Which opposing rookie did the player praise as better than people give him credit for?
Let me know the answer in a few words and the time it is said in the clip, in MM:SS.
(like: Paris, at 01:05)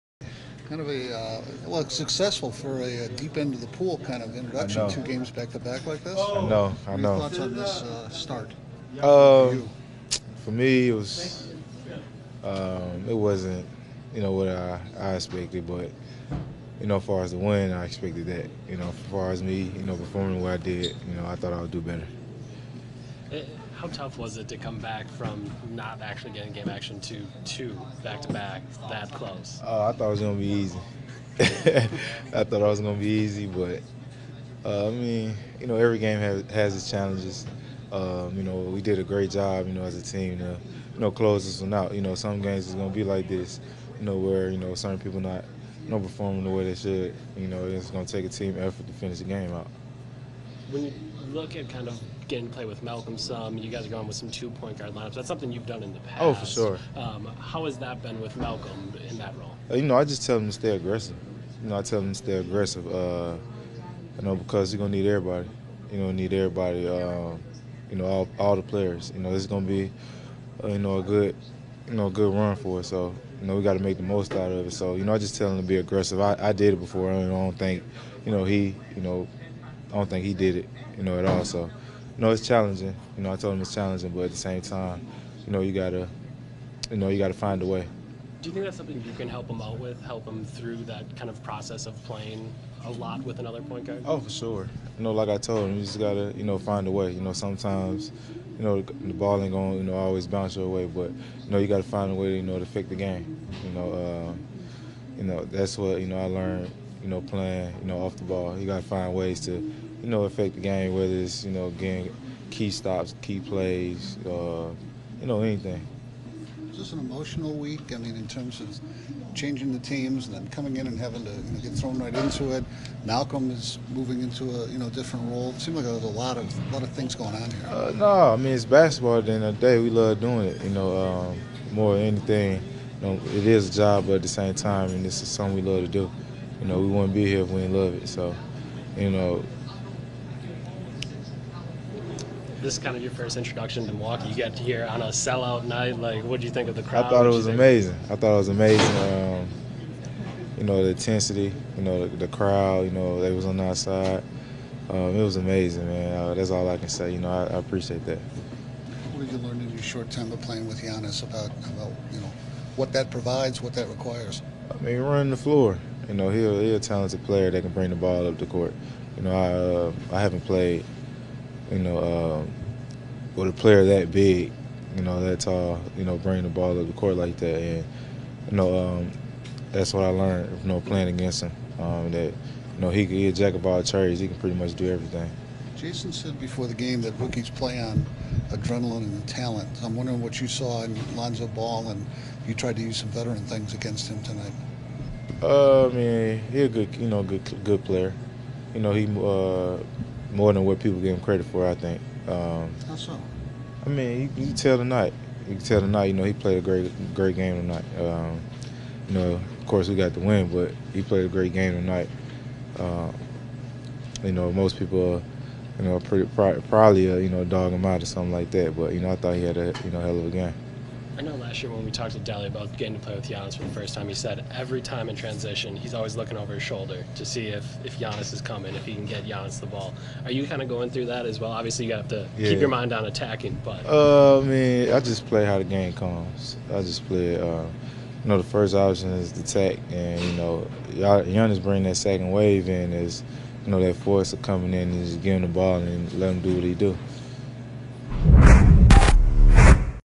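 Lonzo Ball, at 03:11.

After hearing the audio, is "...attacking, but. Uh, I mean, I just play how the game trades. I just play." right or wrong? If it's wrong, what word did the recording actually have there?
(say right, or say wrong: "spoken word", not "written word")
wrong: "comes", not "trades".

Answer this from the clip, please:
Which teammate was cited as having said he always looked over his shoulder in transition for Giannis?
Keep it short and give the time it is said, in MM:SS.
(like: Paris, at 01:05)
Delly, at 03:42.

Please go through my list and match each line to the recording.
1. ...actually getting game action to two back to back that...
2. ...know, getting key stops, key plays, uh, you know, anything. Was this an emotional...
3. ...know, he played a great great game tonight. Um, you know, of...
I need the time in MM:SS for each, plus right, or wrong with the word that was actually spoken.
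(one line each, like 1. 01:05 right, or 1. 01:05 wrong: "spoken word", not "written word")
1. 00:26 right
2. 01:51 right
3. 03:26 right.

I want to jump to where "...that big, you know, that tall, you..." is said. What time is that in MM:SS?
02:53.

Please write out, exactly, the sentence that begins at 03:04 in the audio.
He can pretty much do everything.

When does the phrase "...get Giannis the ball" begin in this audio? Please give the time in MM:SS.
03:49.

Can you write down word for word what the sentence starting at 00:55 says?
That's something you've done in the past.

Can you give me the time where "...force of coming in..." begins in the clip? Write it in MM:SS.
04:03.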